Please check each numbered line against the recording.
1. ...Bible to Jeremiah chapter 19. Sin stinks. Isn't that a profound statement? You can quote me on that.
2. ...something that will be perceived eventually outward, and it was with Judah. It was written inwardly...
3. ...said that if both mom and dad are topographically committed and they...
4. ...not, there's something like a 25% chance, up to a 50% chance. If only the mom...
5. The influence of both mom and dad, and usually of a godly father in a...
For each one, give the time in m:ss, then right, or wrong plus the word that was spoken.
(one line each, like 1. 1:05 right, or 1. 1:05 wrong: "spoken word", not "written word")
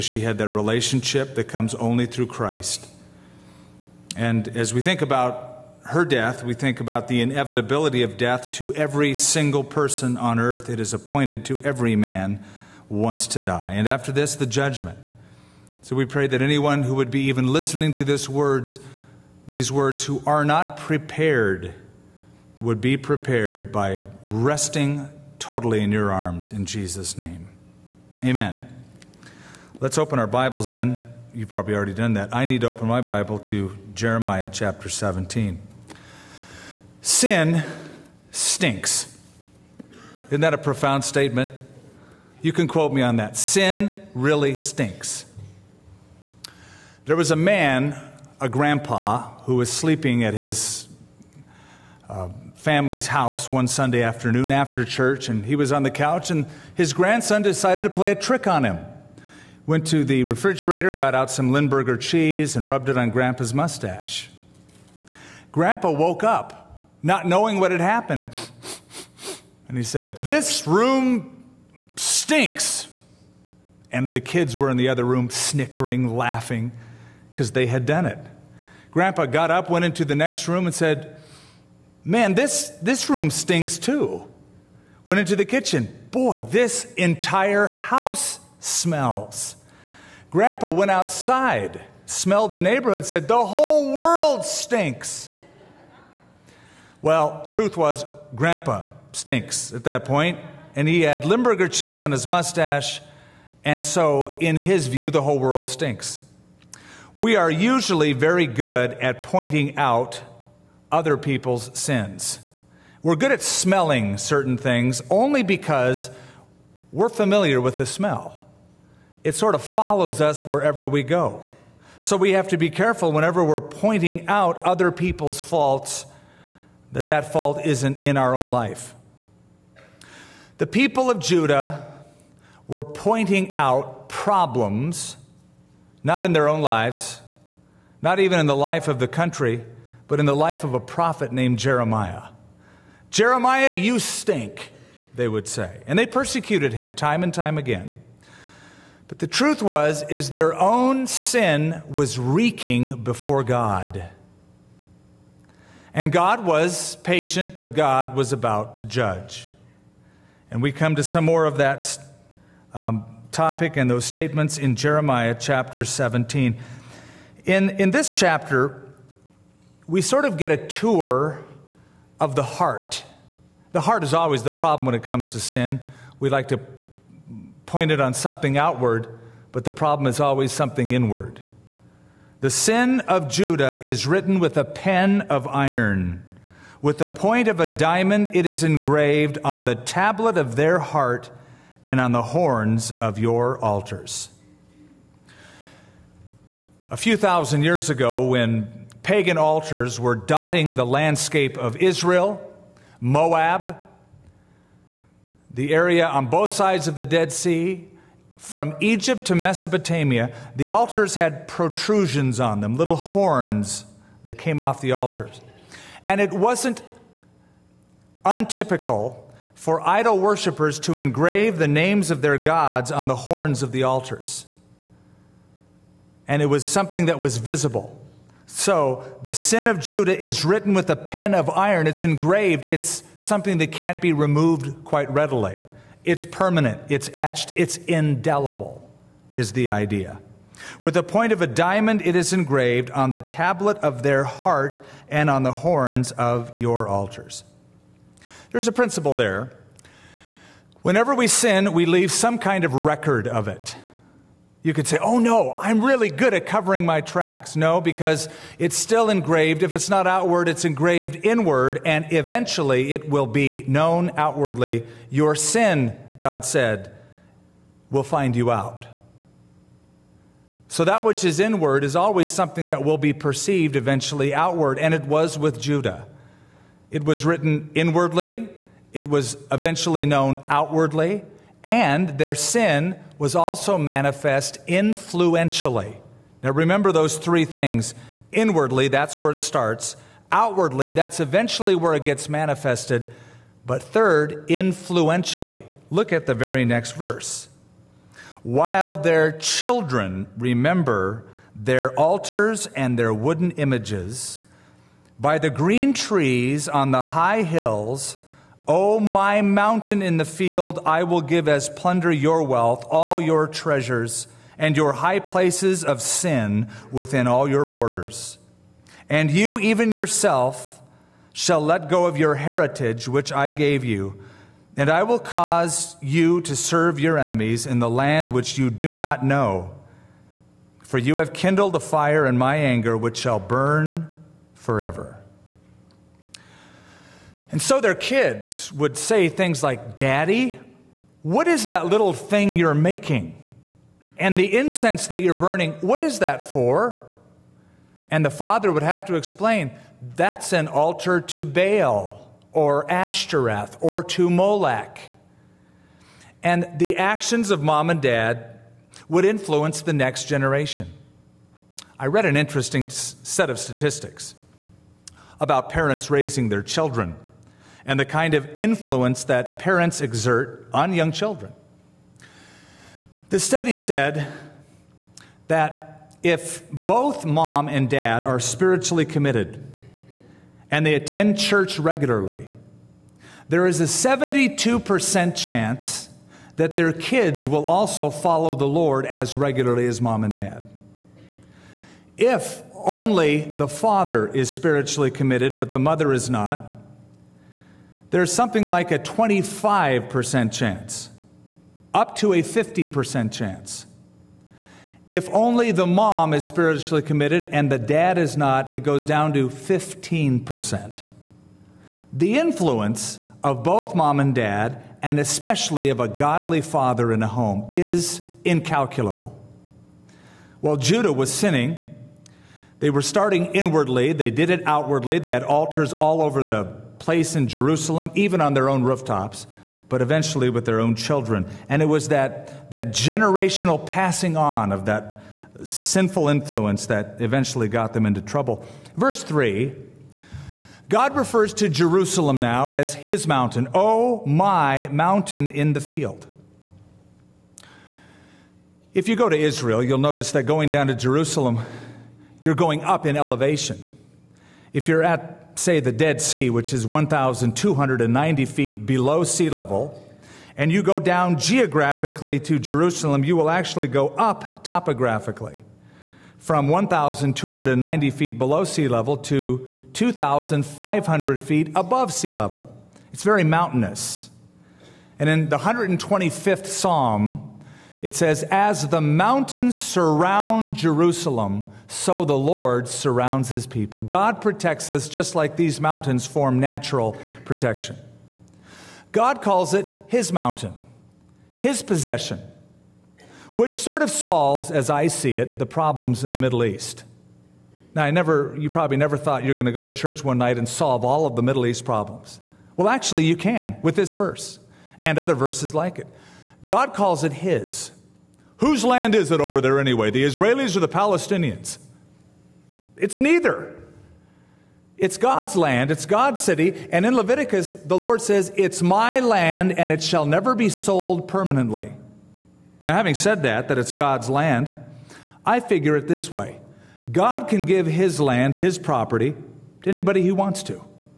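1. 0:33 wrong: "17", not "19"
2. 4:32 right
3. 6:13 wrong: "spiritually", not "topographically"
4. 6:36 right
5. 6:52 wrong: "especially", not "usually".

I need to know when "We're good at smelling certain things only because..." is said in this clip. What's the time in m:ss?
1:53.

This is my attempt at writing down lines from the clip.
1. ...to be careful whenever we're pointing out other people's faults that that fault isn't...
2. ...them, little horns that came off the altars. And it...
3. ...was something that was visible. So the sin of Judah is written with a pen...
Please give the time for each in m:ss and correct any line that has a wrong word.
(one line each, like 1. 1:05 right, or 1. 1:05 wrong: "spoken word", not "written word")
1. 2:02 right
2. 3:32 right
3. 3:46 right.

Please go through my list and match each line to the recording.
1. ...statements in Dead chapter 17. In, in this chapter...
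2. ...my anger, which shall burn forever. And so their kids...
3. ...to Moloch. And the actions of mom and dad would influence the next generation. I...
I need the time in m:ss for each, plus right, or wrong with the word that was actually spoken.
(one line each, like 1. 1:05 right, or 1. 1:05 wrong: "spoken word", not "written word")
1. 2:44 wrong: "Jeremiah", not "Dead"
2. 5:32 right
3. 5:54 right.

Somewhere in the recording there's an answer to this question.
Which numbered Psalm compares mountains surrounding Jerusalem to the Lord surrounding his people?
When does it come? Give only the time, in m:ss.
7:55.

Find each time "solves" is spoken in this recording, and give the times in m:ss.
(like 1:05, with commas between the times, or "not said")
8:14, 8:20.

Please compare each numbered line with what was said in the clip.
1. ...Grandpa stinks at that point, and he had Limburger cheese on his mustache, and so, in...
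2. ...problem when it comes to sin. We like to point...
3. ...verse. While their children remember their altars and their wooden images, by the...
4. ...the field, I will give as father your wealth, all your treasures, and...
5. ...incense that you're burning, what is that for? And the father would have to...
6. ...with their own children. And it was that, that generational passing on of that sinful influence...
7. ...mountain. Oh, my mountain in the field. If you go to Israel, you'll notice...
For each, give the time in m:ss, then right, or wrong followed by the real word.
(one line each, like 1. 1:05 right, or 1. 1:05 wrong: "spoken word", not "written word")
1. 1:38 right
2. 2:54 right
3. 4:56 right
4. 5:10 wrong: "plunder", not "father"
5. 5:44 right
6. 7:10 right
7. 7:23 right.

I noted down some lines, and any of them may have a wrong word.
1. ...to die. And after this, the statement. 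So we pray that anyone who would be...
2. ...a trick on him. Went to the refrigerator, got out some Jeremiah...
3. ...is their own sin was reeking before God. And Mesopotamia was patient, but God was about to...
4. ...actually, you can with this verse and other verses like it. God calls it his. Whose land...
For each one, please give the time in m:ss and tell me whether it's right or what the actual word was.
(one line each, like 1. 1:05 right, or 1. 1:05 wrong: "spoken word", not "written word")
1. 0:13 wrong: "judgment", not "statement"
2. 0:58 wrong: "Limburger", not "Jeremiah"
3. 2:30 wrong: "God", not "Mesopotamia"
4. 8:22 right.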